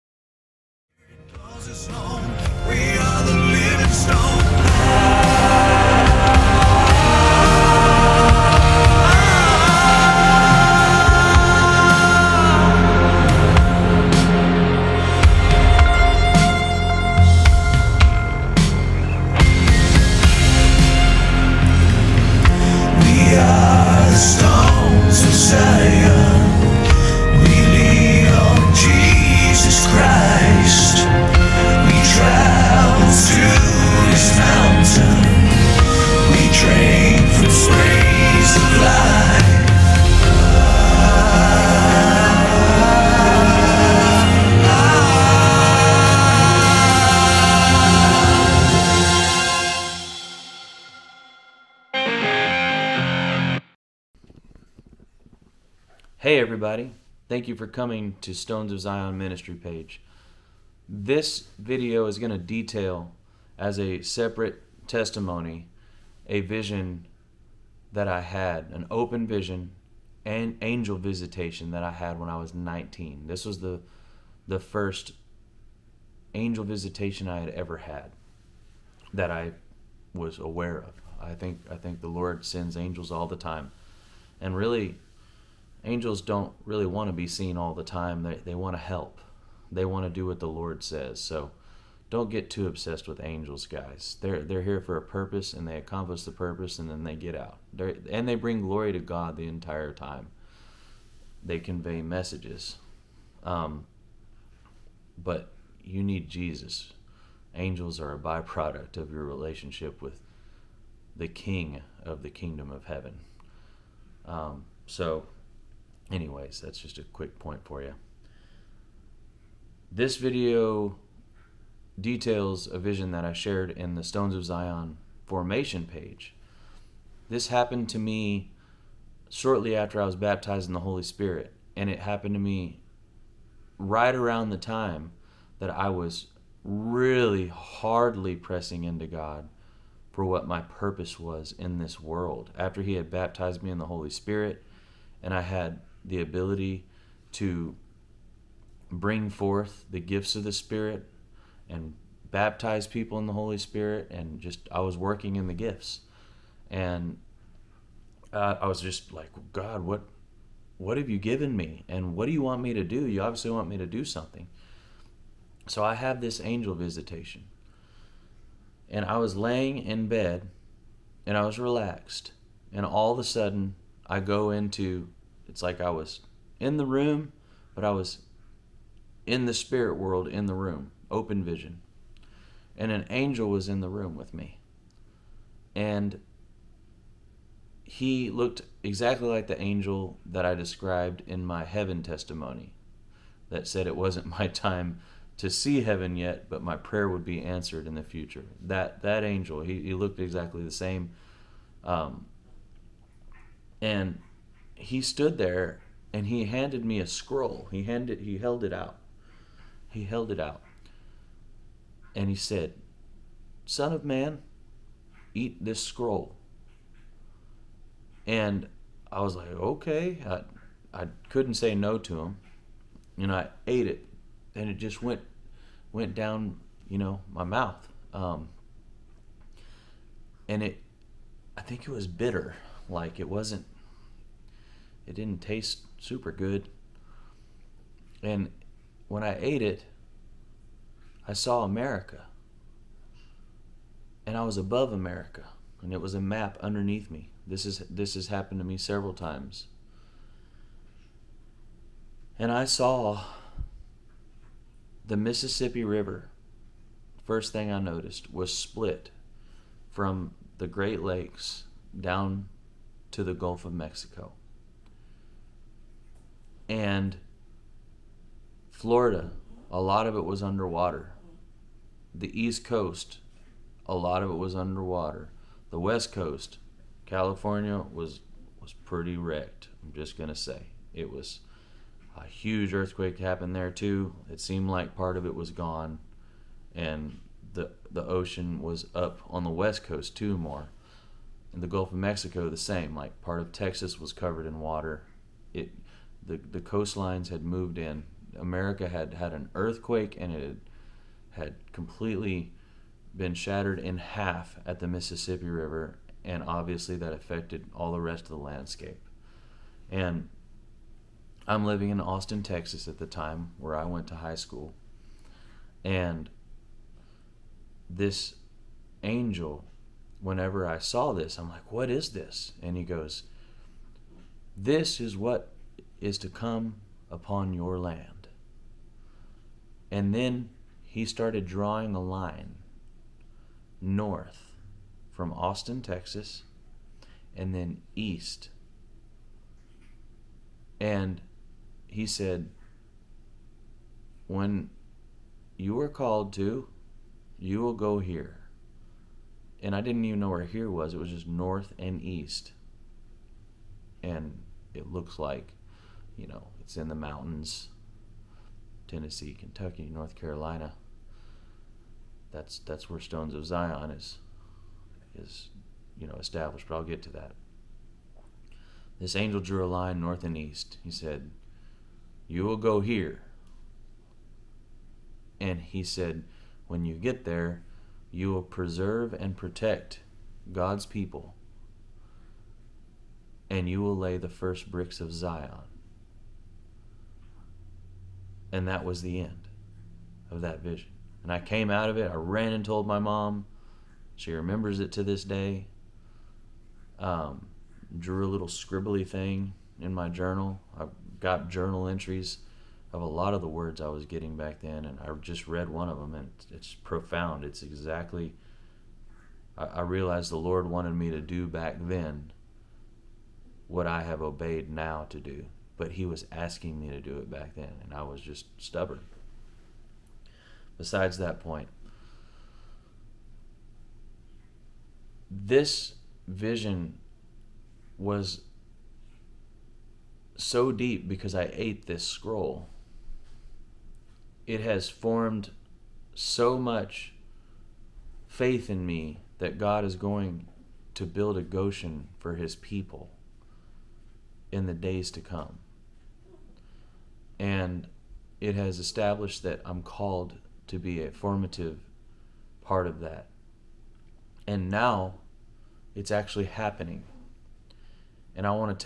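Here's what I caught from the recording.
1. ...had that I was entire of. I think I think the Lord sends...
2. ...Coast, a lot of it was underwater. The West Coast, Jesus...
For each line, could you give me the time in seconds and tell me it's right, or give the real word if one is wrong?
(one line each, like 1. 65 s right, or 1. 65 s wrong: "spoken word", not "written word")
1. 77 s wrong: "aware", not "entire"
2. 272 s wrong: "California", not "Jesus".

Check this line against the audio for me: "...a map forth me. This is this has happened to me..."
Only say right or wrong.
wrong.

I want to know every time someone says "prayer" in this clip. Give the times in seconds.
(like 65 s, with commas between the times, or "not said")
196 s.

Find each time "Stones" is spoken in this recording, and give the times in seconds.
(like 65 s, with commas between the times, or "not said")
58 s, 124 s, 362 s.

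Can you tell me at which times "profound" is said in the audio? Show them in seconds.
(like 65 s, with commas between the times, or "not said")
406 s.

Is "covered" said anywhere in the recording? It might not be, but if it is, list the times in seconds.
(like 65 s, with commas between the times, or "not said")
294 s.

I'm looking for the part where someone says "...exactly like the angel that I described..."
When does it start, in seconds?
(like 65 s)
188 s.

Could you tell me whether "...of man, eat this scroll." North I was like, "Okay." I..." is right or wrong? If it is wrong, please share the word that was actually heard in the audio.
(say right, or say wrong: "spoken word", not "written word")
wrong: "And", not "North".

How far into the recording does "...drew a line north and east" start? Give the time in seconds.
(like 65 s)
369 s.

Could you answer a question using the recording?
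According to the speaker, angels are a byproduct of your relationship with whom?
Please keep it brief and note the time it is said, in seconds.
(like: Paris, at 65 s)
The King of the kingdom of heaven, at 111 s.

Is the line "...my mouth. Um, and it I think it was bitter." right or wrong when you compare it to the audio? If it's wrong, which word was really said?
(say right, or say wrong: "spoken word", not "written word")
right.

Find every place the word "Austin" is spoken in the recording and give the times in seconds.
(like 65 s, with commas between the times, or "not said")
311 s, 335 s.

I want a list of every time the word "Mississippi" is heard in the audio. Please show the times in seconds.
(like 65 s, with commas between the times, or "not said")
255 s, 304 s.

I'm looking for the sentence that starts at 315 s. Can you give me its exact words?
And this angel, whenever I saw this, I'm like, what is this?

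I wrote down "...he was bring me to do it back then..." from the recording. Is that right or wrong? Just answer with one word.
wrong.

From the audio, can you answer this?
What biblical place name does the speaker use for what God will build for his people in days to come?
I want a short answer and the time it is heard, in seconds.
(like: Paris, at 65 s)
Goshen, at 441 s.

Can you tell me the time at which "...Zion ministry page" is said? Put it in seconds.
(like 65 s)
58 s.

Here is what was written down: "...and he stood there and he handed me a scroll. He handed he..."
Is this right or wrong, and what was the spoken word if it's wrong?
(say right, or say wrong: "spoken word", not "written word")
right.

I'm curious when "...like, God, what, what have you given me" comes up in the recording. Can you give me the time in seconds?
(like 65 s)
159 s.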